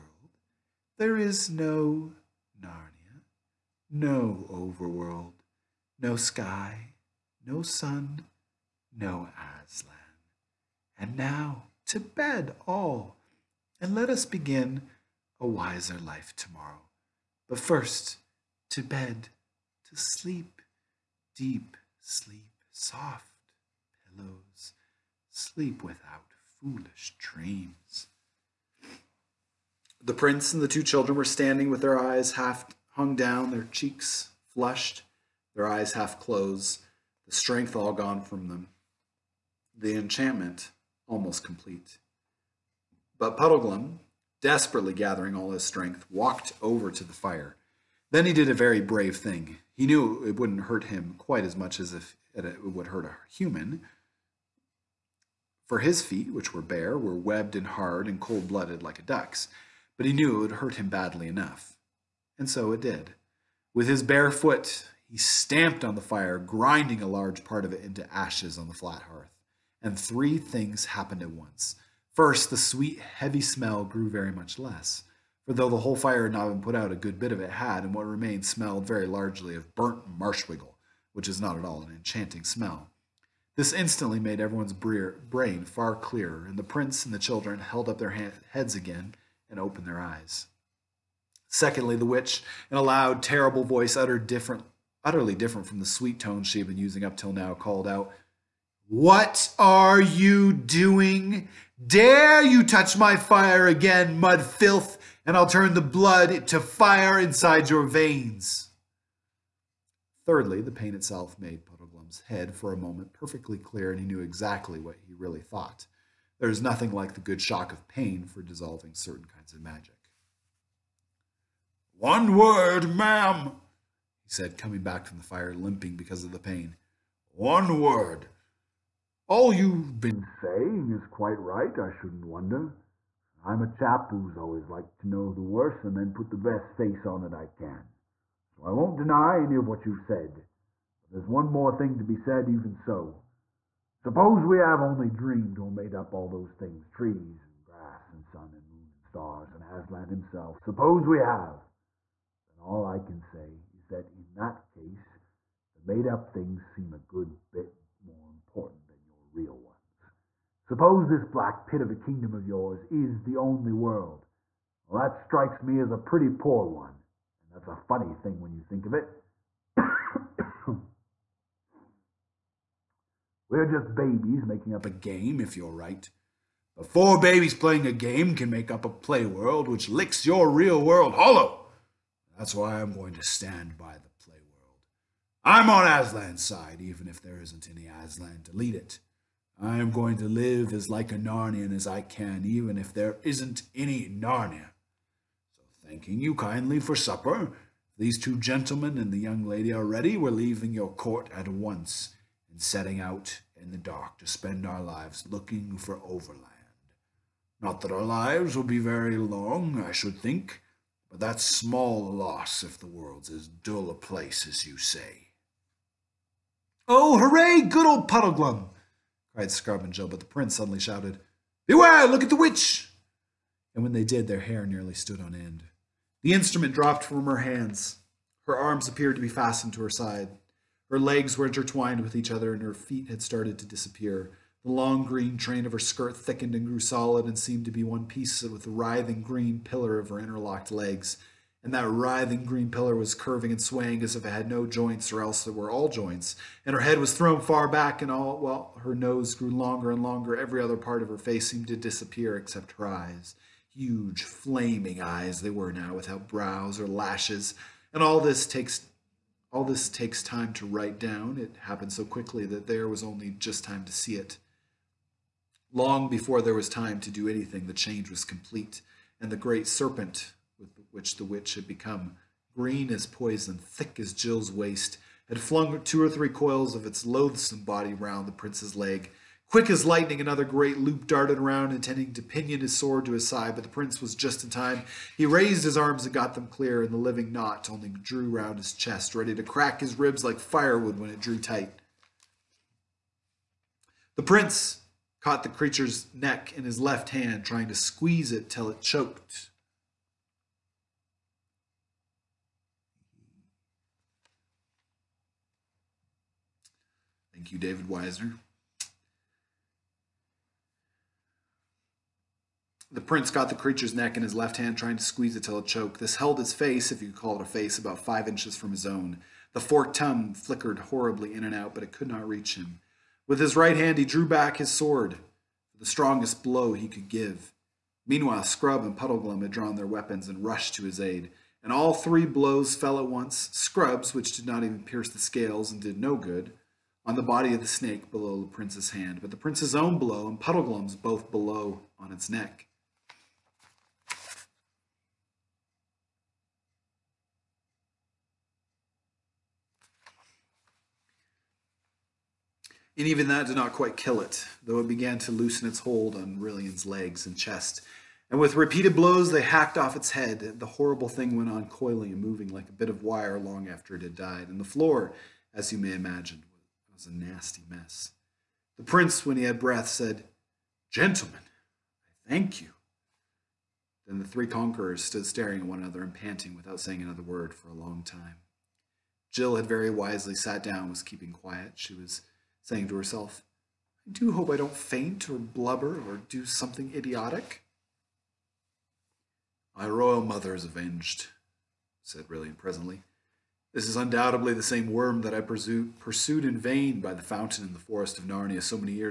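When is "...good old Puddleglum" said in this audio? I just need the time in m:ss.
3:37.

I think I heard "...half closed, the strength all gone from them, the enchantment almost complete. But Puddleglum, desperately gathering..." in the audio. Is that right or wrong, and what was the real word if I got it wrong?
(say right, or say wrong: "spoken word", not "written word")
right.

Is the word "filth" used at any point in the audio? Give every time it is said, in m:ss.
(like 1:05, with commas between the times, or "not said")
1:44.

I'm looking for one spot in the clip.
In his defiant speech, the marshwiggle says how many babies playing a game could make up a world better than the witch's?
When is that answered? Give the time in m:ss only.
2:56.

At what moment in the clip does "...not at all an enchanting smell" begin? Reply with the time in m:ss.
1:21.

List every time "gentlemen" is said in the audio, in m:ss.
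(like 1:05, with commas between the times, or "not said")
3:18, 6:10.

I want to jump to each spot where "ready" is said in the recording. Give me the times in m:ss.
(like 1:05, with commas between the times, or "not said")
3:19, 4:49.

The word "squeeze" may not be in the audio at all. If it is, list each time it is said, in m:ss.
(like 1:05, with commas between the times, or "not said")
4:57, 5:15.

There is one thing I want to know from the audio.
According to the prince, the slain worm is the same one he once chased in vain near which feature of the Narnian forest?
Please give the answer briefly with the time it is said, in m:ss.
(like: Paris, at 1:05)
the fountain, at 6:37.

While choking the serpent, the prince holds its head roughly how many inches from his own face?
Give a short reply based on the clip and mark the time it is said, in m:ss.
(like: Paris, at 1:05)
5, at 5:18.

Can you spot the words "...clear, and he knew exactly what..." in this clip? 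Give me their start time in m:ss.
1:53.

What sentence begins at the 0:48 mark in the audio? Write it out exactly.
Then he did a very brave thing.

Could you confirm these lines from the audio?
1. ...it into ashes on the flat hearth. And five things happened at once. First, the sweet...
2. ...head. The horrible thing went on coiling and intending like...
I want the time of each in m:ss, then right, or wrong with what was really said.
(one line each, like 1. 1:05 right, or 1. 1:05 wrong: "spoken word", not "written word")
1. 1:07 wrong: "three", not "five"
2. 6:00 wrong: "moving", not "intending".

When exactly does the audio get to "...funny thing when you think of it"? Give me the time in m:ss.
2:47.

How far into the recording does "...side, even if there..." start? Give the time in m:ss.
3:06.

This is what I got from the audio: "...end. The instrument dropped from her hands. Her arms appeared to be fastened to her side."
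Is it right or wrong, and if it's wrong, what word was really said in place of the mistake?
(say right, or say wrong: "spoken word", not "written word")
right.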